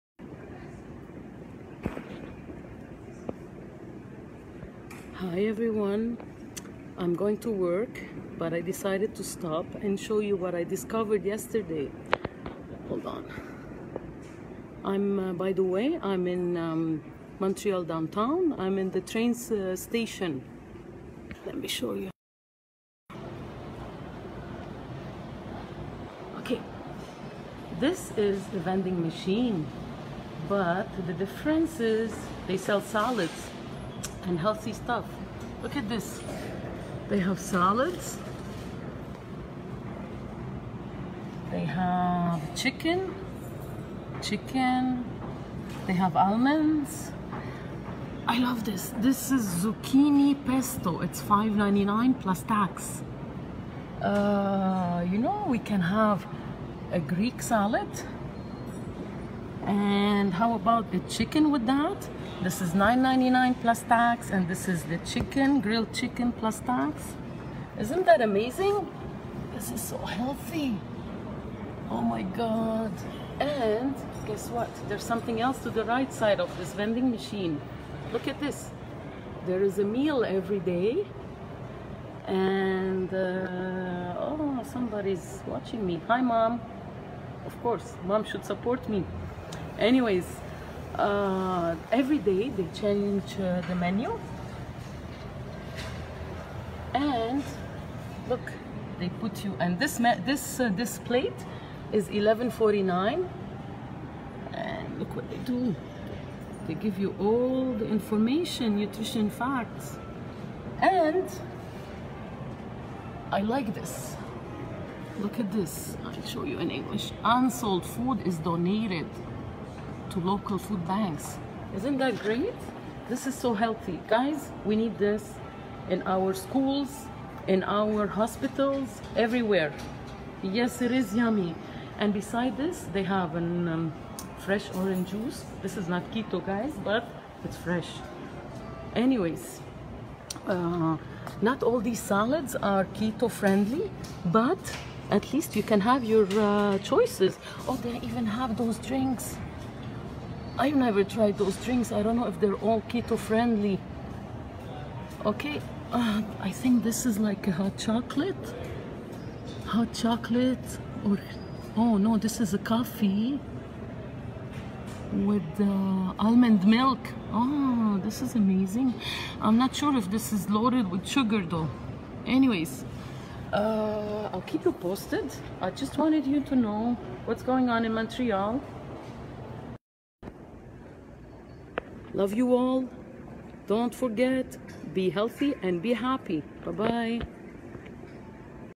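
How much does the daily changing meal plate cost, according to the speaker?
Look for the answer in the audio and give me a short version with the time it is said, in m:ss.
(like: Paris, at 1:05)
$11.49, at 1:42.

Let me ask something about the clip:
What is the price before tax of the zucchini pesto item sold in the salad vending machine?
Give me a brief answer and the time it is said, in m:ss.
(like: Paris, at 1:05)
$5.99, at 0:51.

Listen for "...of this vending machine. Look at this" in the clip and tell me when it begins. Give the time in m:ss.
1:16.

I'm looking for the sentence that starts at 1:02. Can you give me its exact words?
This is $9.99 plus tax, and this is the chicken, grilled chicken plus tax.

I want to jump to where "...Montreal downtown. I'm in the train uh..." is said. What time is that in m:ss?
0:17.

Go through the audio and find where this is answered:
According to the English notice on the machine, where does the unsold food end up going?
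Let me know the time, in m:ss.
2:00.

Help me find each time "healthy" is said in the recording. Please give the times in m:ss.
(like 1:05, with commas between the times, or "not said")
0:34, 1:09, 2:03, 3:05.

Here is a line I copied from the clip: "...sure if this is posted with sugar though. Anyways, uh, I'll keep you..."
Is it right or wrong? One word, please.
wrong.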